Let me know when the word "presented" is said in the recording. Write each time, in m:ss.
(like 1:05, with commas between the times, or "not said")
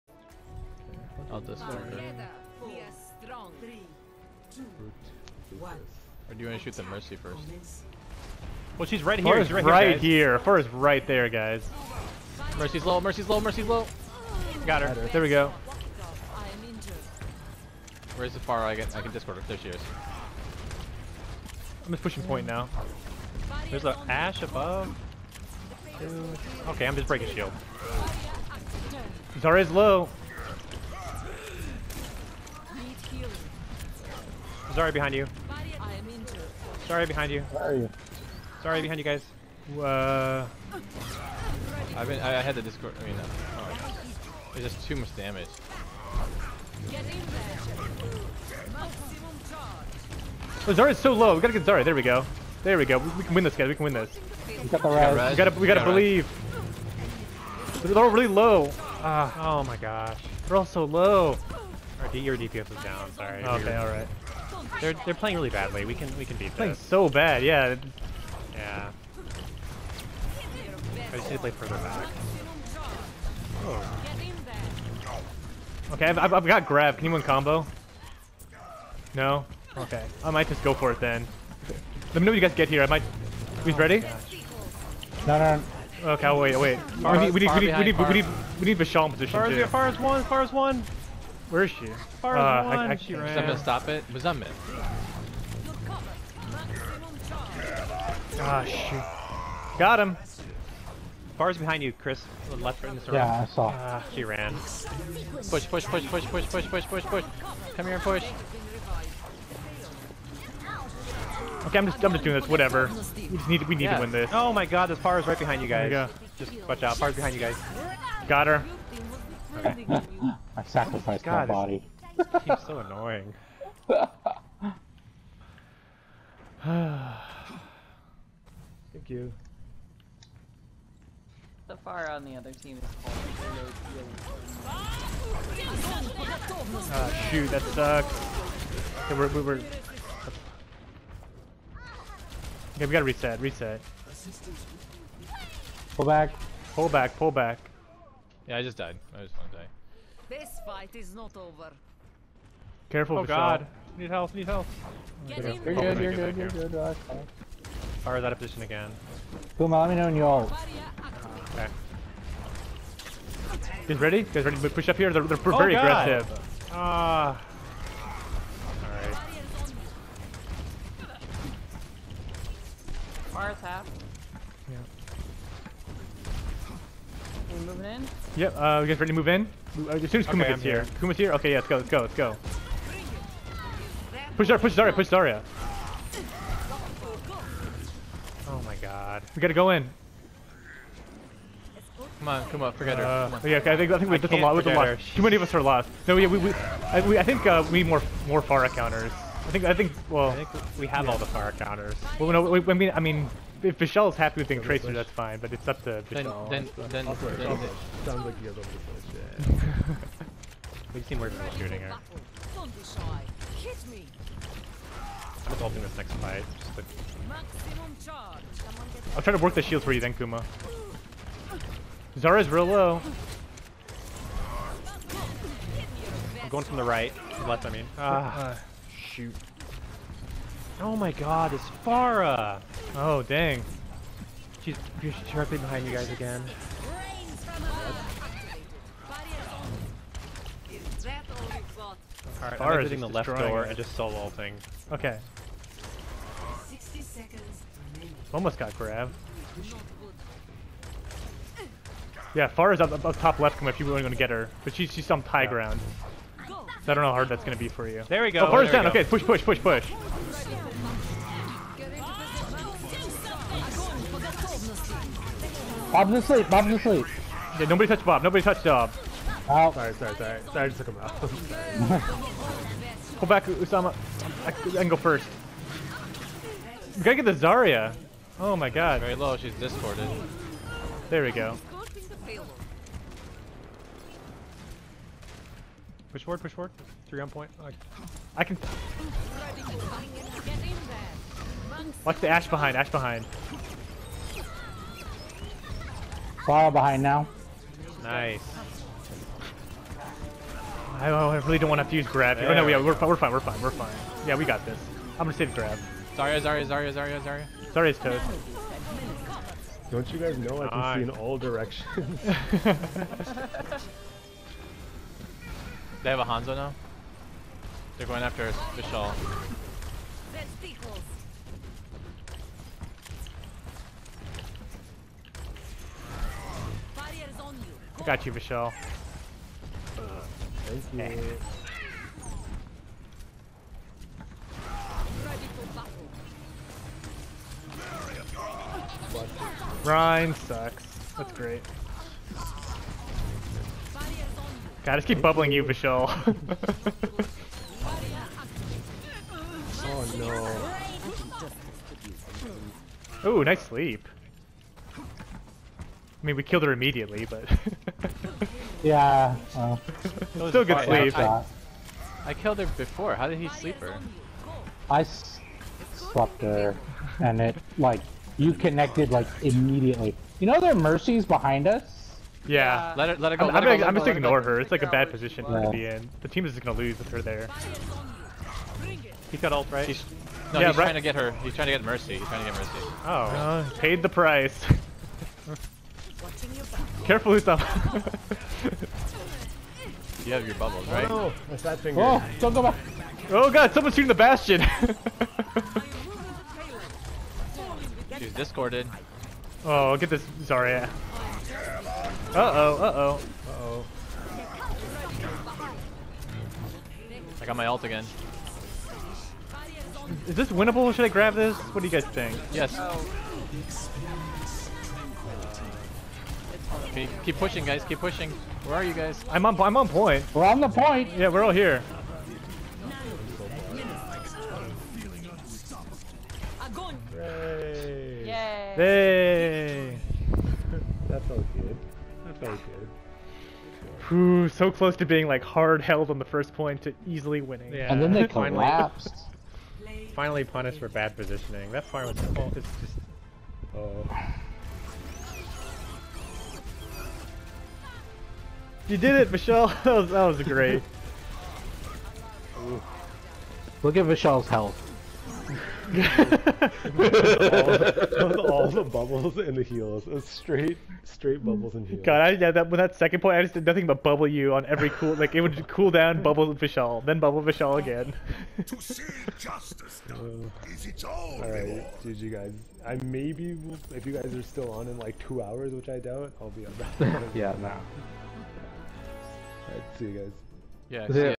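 not said.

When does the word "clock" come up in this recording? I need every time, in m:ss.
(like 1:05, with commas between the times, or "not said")
not said.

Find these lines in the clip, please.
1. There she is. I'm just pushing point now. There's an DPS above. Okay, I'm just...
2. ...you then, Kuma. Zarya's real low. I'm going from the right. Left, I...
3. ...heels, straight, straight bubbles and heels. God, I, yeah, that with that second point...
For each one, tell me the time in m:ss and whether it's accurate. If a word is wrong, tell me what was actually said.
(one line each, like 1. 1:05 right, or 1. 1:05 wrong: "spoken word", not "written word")
1. 0:19 wrong: "Ashe", not "DPS"
2. 3:39 right
3. 7:39 right.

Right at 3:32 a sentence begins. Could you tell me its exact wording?
I'm just hoping this next fight.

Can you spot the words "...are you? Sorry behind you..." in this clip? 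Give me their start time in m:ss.
0:37.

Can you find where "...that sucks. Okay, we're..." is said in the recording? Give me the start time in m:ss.
2:17.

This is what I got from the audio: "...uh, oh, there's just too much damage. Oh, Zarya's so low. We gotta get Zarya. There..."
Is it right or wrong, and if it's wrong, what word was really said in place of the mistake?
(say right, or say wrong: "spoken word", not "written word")
right.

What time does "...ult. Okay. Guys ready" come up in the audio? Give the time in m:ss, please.
2:40.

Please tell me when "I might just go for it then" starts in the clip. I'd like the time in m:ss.
1:20.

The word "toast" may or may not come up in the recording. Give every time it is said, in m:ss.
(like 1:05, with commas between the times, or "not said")
5:07.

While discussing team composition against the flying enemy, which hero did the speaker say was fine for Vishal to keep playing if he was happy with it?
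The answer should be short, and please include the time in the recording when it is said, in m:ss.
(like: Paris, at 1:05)
Tracer, at 3:24.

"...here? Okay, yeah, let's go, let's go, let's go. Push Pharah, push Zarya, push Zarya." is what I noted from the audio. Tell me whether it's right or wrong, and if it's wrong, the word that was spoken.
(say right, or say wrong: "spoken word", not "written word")
wrong: "Zarya", not "Pharah".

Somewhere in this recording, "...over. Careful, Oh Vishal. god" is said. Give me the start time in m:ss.
2:31.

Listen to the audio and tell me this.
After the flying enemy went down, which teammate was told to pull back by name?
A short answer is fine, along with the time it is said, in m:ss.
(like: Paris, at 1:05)
Usama, at 4:33.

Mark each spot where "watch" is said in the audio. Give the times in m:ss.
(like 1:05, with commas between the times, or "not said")
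1:56, 4:52.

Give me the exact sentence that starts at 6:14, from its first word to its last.
It's like a bad position yeah.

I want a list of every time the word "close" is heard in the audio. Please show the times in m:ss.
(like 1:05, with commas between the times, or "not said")
7:14.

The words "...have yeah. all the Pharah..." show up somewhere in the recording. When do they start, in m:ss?
3:20.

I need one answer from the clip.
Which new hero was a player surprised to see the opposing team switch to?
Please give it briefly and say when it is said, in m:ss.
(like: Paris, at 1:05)
Hanzo, at 5:16.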